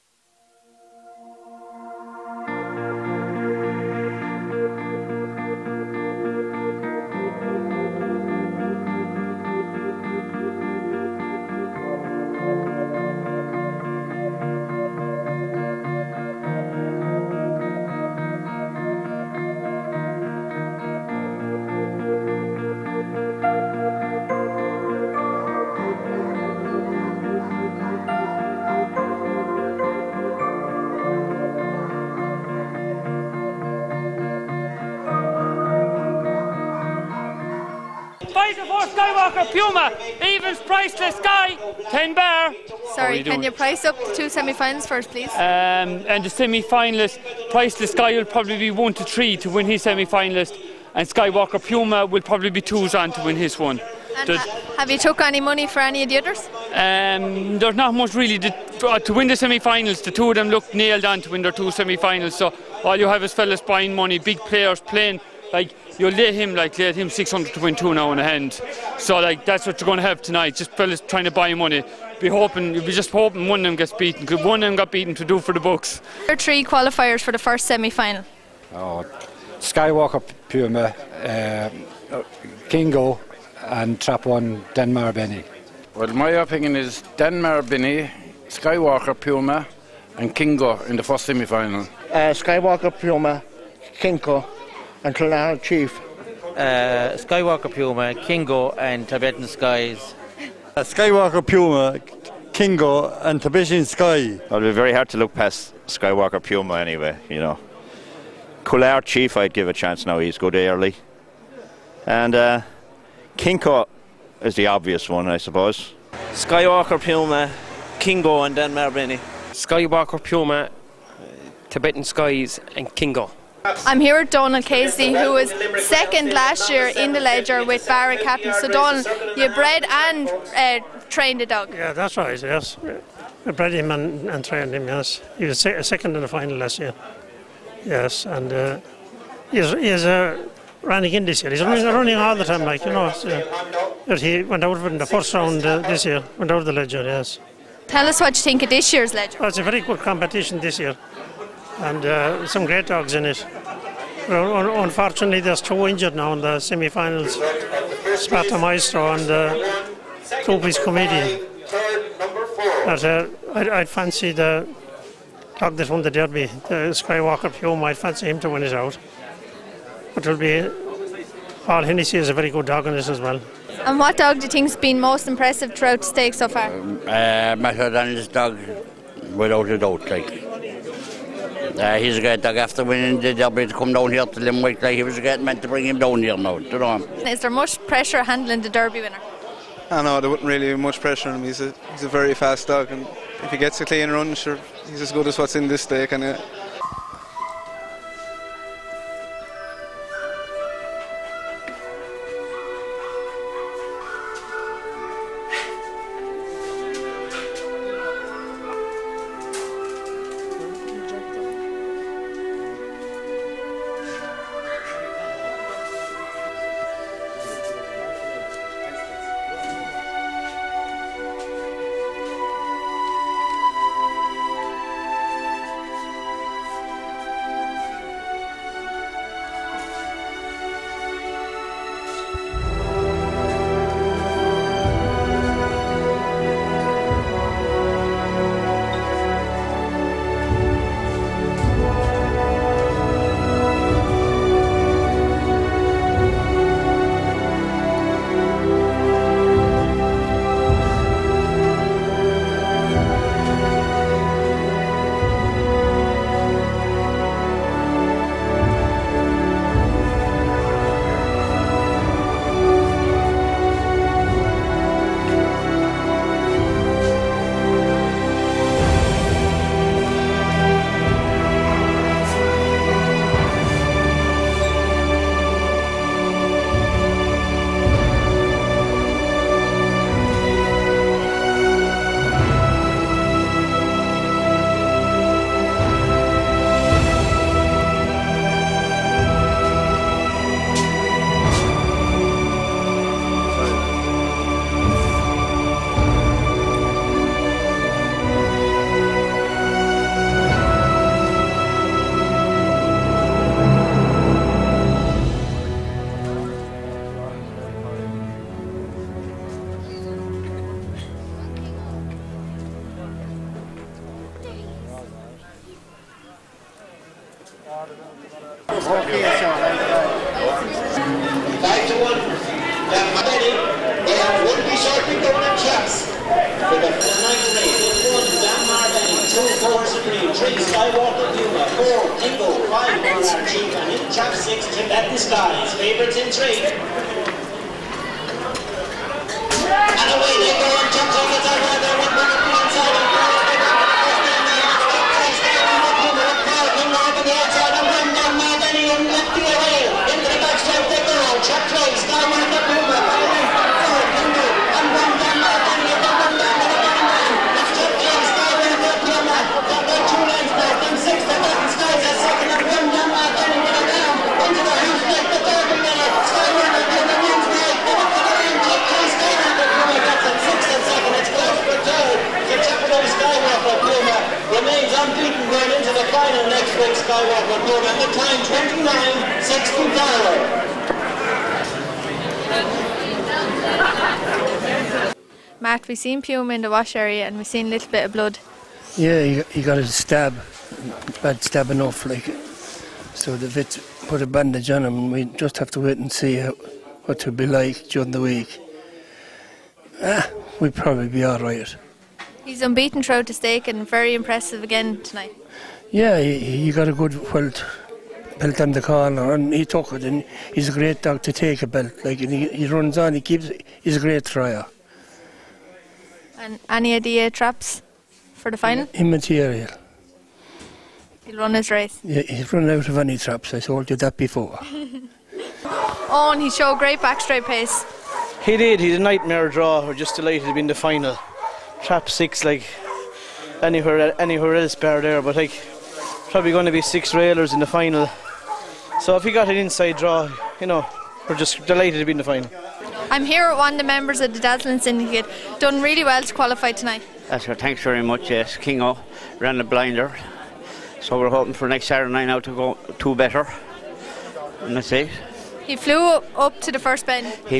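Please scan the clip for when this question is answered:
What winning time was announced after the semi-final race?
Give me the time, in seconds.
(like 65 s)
385 s.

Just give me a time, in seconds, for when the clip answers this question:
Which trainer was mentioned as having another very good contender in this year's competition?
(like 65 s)
171 s.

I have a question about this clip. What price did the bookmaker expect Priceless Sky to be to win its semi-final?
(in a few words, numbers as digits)
1 to 3.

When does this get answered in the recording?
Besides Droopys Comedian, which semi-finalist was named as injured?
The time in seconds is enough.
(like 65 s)
158 s.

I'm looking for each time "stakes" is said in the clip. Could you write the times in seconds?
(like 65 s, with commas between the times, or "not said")
176 s, 403 s.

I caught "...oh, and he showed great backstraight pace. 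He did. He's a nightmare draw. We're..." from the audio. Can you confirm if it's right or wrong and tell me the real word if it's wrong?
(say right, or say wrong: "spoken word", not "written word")
right.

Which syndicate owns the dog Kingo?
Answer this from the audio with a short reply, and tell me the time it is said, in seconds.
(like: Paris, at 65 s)
Dazzling Syndicate, at 444 s.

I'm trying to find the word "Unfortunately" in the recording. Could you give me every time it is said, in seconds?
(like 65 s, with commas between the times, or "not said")
154 s.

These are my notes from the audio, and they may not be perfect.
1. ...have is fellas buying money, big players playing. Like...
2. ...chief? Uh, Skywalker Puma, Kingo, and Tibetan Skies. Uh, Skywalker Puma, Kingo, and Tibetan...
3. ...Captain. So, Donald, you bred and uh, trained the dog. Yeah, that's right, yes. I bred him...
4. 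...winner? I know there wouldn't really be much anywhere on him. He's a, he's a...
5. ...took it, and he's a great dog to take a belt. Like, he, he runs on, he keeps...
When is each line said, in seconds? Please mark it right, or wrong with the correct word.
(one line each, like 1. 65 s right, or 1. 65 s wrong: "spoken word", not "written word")
1. 63 s right
2. 95 s right
3. 128 s right
4. 189 s wrong: "pressure", not "anywhere"
5. 409 s right.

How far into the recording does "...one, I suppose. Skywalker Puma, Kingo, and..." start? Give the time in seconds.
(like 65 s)
115 s.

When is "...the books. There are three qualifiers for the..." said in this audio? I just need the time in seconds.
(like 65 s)
75 s.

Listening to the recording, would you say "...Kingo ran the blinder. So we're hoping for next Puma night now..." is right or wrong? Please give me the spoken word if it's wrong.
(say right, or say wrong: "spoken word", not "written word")
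wrong: "Saturday", not "Puma".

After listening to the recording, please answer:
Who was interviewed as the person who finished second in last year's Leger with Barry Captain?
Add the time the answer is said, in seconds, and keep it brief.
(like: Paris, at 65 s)
Donald Casey, at 124 s.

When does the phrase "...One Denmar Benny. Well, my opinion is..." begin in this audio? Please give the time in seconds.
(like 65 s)
84 s.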